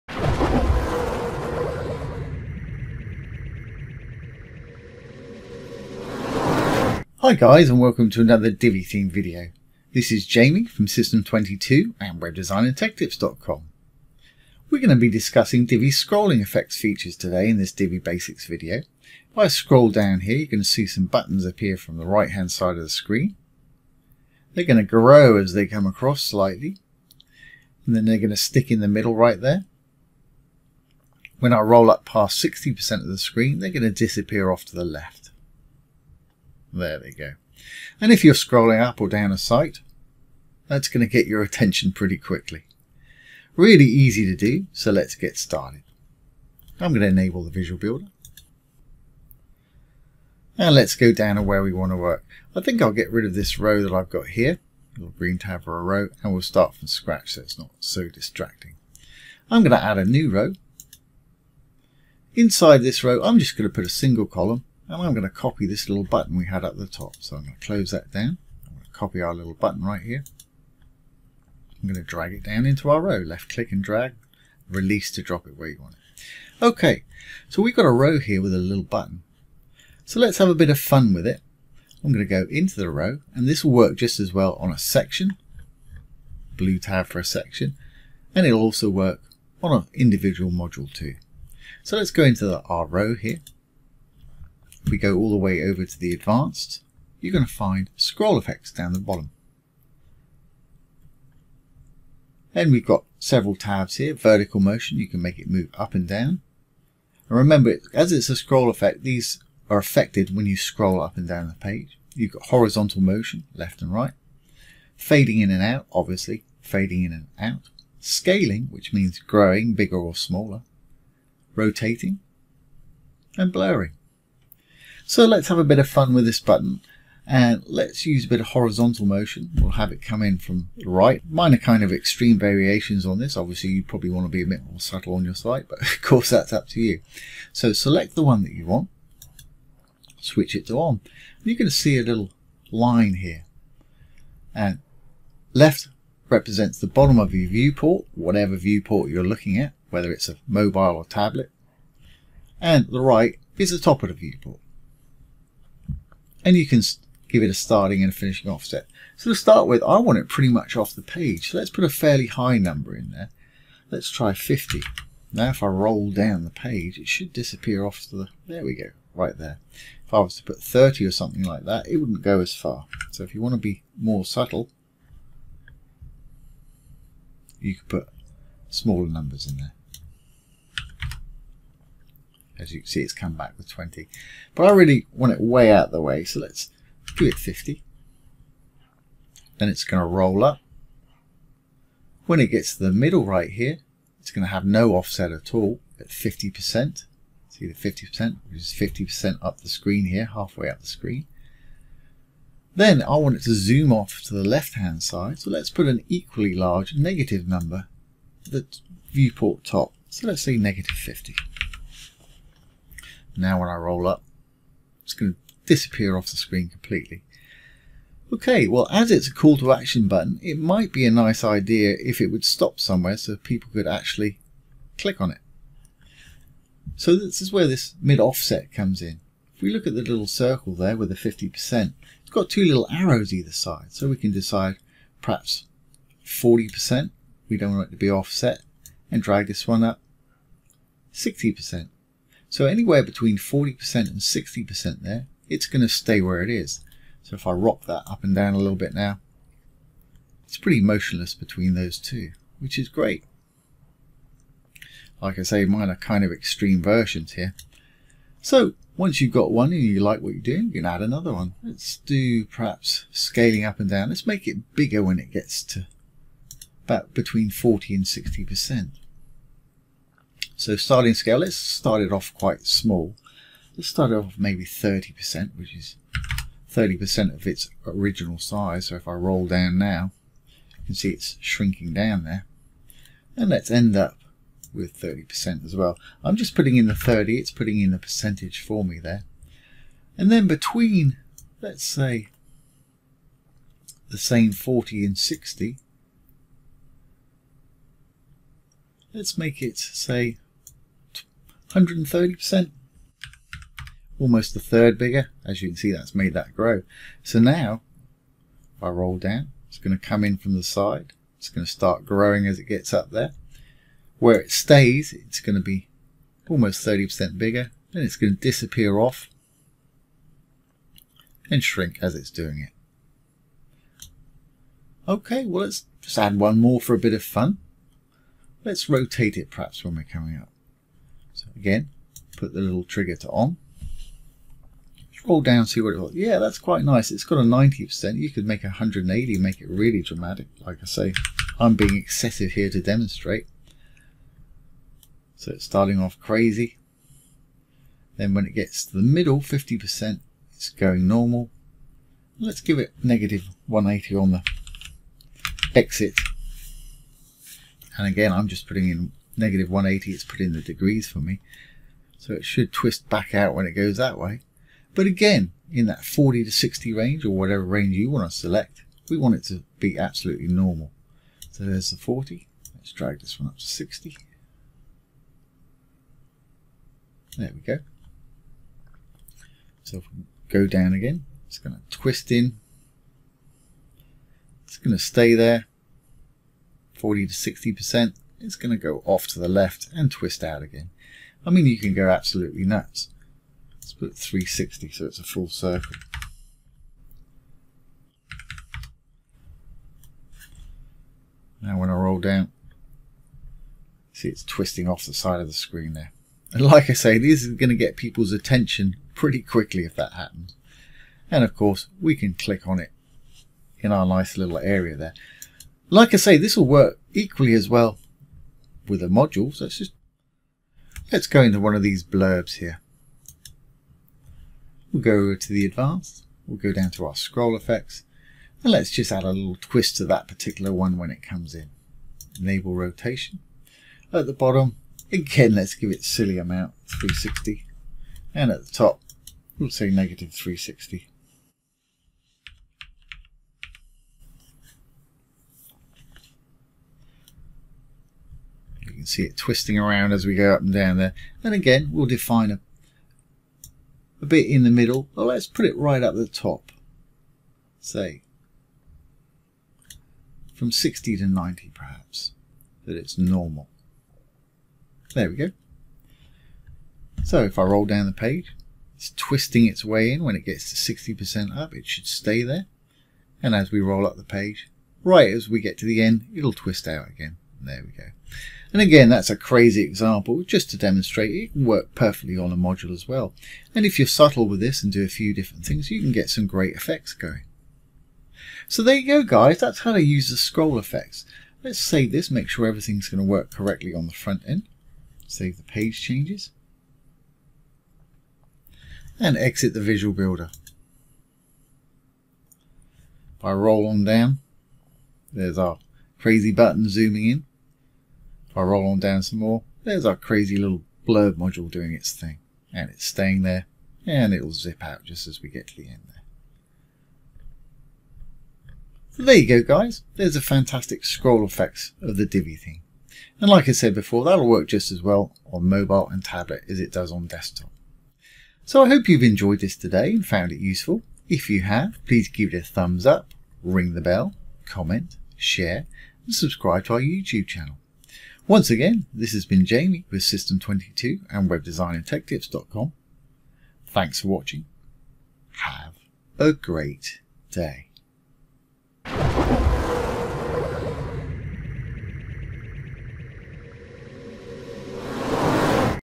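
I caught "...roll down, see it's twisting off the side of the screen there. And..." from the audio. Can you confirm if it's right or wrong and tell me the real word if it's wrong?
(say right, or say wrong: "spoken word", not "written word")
right.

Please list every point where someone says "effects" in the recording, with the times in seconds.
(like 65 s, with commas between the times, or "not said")
16 s, 98 s, 108 s, 427 s, 486 s, 490 s, 521 s.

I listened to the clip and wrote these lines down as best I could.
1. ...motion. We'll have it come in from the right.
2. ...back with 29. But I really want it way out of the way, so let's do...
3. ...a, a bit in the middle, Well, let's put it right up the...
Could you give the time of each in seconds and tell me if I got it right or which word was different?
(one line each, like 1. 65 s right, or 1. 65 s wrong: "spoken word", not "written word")
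1. 129 s right
2. 183 s wrong: "20", not "29"
3. 452 s right.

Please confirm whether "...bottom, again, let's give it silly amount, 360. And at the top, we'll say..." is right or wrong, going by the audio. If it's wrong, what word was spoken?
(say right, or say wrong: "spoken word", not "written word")
right.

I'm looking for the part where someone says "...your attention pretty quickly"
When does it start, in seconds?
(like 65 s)
41 s.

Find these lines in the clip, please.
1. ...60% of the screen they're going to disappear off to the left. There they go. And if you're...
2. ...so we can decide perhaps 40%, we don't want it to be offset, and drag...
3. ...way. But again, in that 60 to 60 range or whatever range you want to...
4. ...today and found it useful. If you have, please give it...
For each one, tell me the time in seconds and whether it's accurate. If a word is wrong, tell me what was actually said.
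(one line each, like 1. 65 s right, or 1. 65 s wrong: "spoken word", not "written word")
1. 32 s right
2. 233 s right
3. 364 s wrong: "40", not "60"
4. 529 s right.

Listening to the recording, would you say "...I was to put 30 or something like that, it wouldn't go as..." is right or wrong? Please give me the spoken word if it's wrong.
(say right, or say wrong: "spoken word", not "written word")
right.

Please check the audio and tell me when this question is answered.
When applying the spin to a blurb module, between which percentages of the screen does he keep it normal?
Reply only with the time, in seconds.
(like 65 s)
460 s.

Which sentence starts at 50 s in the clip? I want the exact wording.
And let's go down to where we want to work.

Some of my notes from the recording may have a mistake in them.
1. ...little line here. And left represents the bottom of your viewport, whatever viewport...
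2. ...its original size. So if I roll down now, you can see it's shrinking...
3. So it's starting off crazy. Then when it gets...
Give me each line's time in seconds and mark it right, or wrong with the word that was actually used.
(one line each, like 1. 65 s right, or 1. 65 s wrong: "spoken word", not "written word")
1. 142 s right
2. 277 s right
3. 345 s right.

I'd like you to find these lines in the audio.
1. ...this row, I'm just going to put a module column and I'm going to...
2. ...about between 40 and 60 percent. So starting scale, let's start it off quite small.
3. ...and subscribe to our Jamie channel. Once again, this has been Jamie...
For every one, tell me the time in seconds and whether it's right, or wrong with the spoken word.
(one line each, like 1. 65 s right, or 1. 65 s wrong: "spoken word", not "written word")
1. 62 s wrong: "single", not "module"
2. 266 s right
3. 536 s wrong: "YouTube", not "Jamie".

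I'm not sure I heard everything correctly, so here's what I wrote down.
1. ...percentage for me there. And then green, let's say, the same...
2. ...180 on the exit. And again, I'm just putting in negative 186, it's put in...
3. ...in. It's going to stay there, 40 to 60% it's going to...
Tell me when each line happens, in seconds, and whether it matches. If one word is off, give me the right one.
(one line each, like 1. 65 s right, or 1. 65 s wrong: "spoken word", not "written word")
1. 287 s wrong: "between", not "green"
2. 353 s wrong: "180", not "186"
3. 382 s right.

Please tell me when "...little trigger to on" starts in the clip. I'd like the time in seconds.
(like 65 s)
332 s.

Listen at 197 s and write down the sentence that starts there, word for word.
See the 50%, which is 50% up the screen here, halfway up the screen.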